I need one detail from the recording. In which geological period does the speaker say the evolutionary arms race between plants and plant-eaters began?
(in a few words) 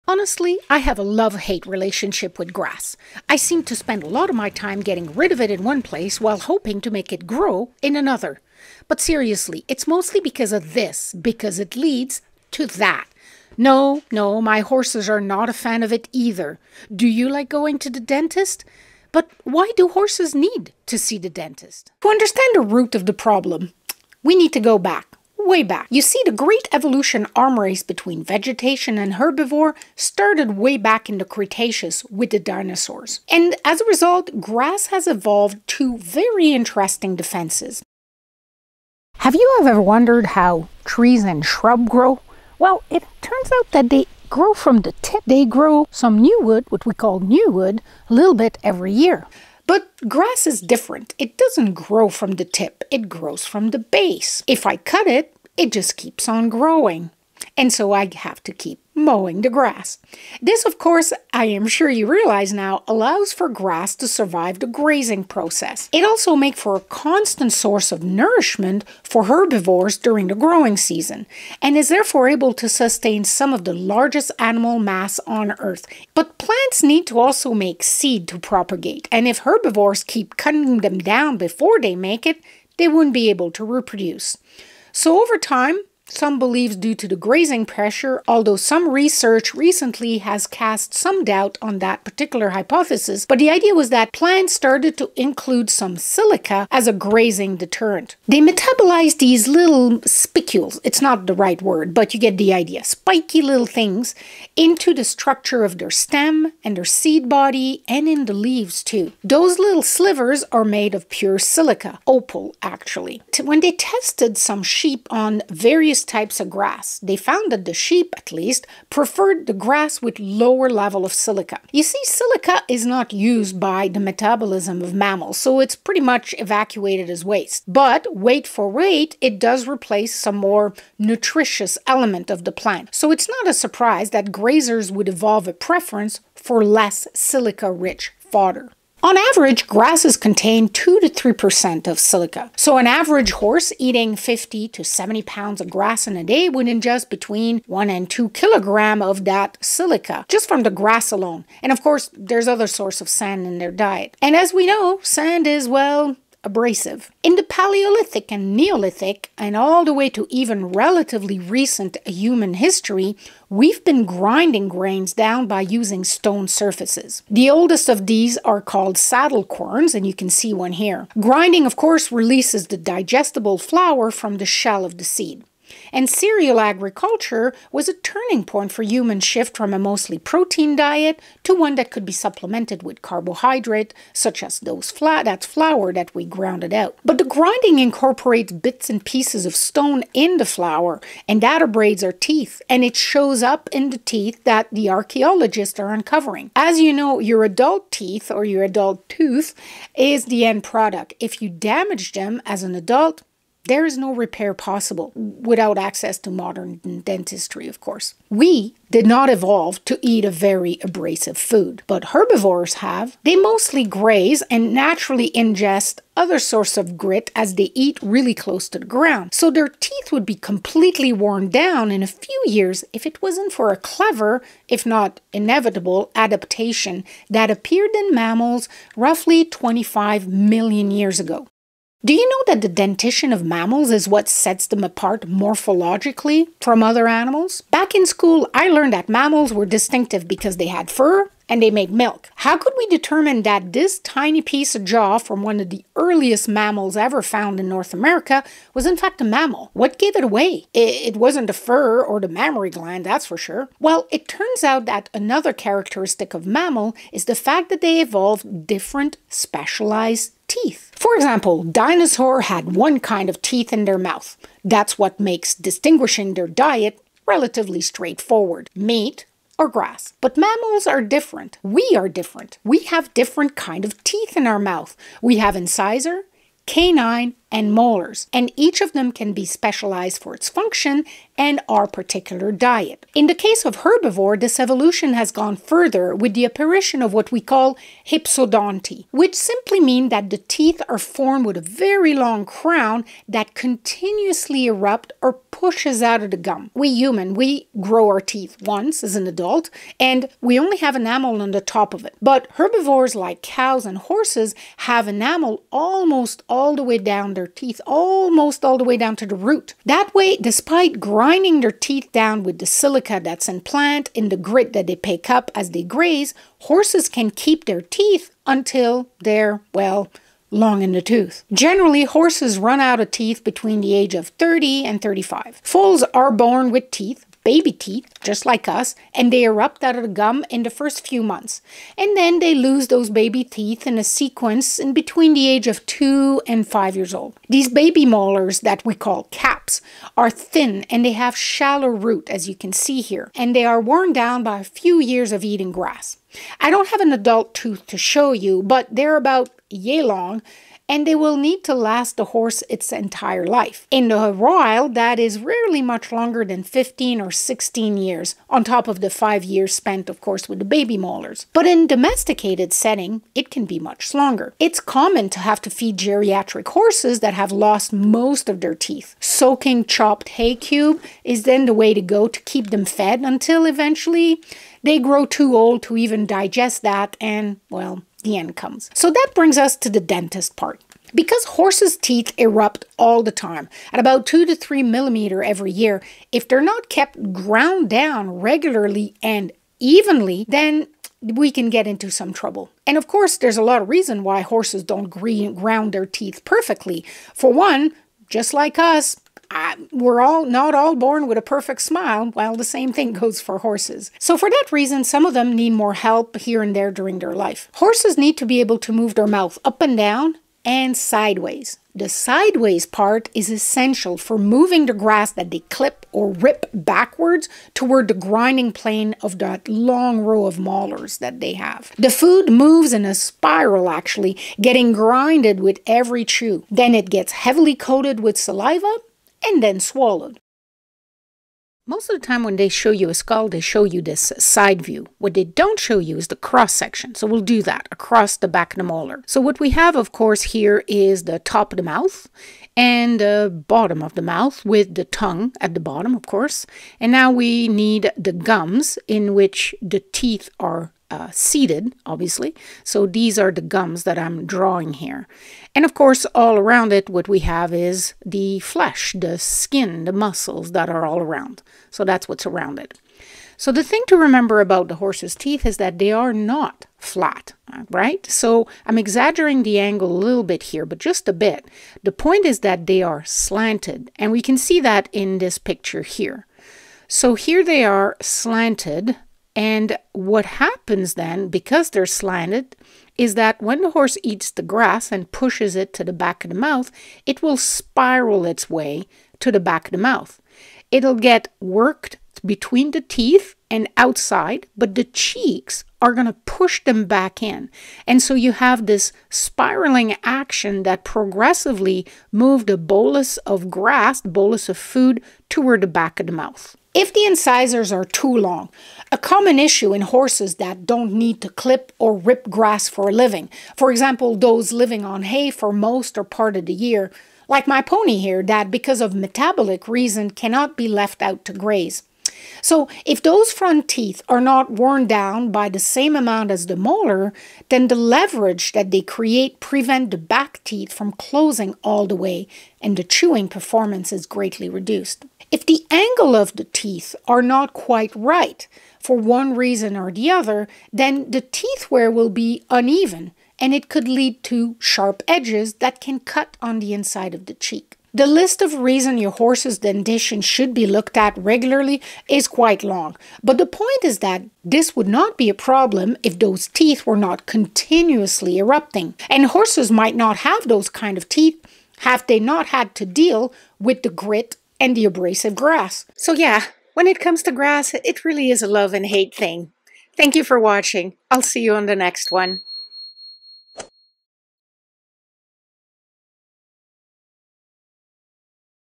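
Cretaceous.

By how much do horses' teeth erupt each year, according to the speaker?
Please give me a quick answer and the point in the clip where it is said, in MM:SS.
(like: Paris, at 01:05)
2 to 3 millimeters, at 06:24.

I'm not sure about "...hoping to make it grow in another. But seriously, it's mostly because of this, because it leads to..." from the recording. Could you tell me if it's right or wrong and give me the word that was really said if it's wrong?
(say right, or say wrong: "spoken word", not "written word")
right.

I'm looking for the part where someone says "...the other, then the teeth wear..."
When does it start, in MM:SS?
09:00.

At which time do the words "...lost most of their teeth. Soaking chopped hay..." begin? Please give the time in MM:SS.
06:07.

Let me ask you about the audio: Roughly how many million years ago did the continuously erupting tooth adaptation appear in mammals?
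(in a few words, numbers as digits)
25 million.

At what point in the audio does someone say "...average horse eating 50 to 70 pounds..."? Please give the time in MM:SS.
02:22.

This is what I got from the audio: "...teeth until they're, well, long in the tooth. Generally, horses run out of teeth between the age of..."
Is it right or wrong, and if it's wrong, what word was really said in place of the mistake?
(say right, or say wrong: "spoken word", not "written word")
right.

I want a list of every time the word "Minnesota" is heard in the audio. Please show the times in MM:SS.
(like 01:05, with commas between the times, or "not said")
not said.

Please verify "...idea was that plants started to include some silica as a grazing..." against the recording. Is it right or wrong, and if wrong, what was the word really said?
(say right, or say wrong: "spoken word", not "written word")
right.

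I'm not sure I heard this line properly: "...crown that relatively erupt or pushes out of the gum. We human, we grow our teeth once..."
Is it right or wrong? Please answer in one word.
wrong.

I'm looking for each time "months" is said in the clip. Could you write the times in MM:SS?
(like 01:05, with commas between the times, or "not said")
05:31.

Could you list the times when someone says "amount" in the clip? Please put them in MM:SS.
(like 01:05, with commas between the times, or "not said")
08:46.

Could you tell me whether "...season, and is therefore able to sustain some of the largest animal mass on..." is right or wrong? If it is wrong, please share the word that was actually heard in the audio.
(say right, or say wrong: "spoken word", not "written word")
right.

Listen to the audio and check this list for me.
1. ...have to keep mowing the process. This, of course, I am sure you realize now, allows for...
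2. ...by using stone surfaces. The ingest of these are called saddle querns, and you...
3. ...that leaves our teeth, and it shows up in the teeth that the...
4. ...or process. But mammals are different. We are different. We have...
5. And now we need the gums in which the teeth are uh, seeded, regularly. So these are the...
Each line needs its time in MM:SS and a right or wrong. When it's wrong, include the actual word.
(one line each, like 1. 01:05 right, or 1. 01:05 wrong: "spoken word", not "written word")
1. 00:58 wrong: "grass", not "process"
2. 02:45 wrong: "oldest", not "ingest"
3. 03:11 wrong: "abrades", not "leaves"
4. 04:29 wrong: "grass", not "process"
5. 07:26 wrong: "obviously", not "regularly".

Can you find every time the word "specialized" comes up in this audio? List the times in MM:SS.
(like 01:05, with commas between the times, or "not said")
04:19, 04:39.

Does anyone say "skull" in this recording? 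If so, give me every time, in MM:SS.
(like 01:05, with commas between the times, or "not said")
07:13.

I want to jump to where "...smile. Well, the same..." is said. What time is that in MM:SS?
06:41.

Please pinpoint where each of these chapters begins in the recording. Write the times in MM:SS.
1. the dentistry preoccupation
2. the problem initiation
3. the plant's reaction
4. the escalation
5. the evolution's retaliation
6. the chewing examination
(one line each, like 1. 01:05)
1. 06:18
2. 00:21
3. 00:37
4. 01:24
5. 03:50
6. 07:10.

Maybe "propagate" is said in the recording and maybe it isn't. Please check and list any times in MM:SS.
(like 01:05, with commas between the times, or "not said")
01:18.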